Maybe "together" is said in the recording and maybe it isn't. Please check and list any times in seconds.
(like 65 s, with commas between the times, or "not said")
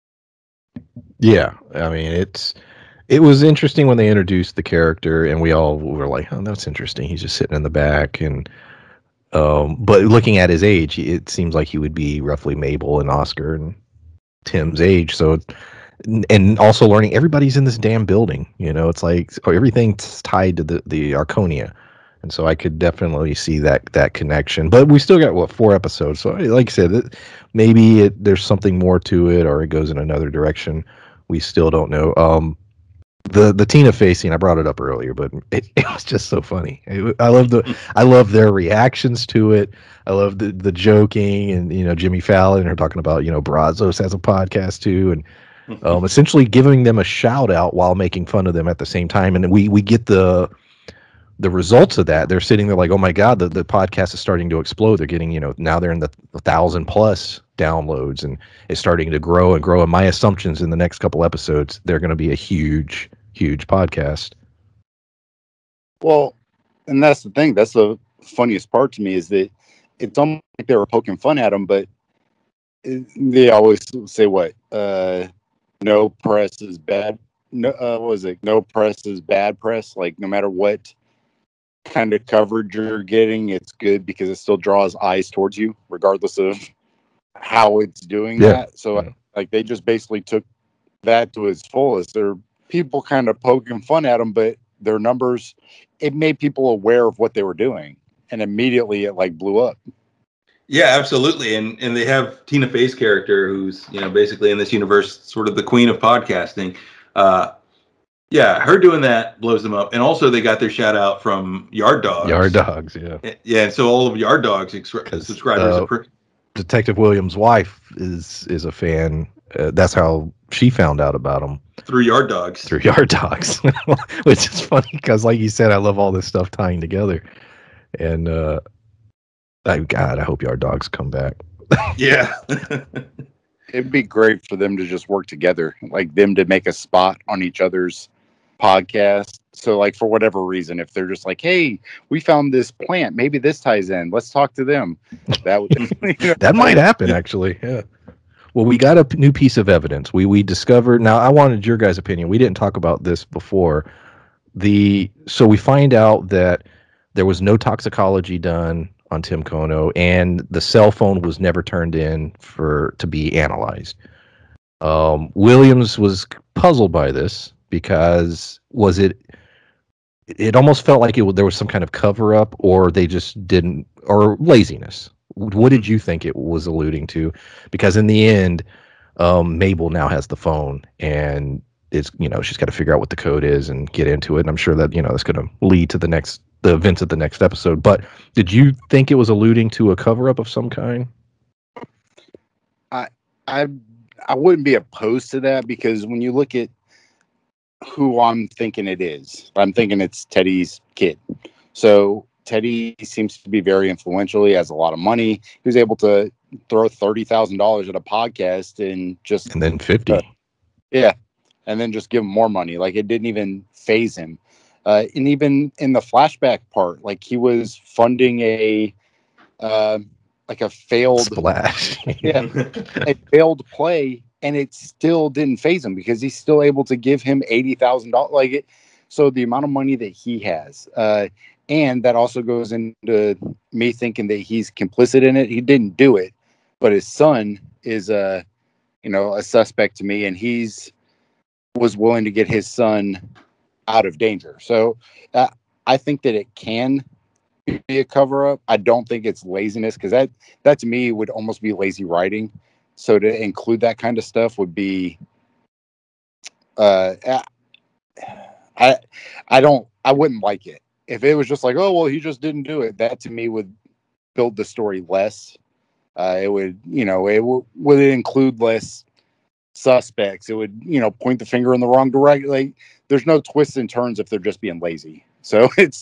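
126 s, 135 s.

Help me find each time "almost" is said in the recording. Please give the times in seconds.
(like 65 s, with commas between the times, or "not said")
70 s, 170 s, 251 s.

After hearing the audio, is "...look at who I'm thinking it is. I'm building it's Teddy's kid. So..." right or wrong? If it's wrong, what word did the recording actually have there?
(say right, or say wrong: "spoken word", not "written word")
wrong: "thinking", not "building".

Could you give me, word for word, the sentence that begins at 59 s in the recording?
And my assumptions in the next couple episodes, they're going to be a huge, huge podcast.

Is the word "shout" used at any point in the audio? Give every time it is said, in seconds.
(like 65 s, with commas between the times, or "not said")
47 s, 110 s.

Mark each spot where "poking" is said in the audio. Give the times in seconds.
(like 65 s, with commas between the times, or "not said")
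70 s, 93 s.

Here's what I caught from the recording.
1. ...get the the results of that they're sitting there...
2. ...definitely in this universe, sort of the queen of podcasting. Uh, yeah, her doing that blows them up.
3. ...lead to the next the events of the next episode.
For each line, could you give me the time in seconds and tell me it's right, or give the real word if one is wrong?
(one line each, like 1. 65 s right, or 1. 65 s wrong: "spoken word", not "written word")
1. 49 s right
2. 104 s wrong: "basically", not "definitely"
3. 185 s right.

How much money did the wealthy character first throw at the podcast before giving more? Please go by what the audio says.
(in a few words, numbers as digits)
$30,000.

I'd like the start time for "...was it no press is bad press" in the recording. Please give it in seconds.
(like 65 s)
78 s.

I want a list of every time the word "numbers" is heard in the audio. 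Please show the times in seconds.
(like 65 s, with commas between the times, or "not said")
94 s.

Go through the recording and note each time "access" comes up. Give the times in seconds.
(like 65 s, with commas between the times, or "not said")
not said.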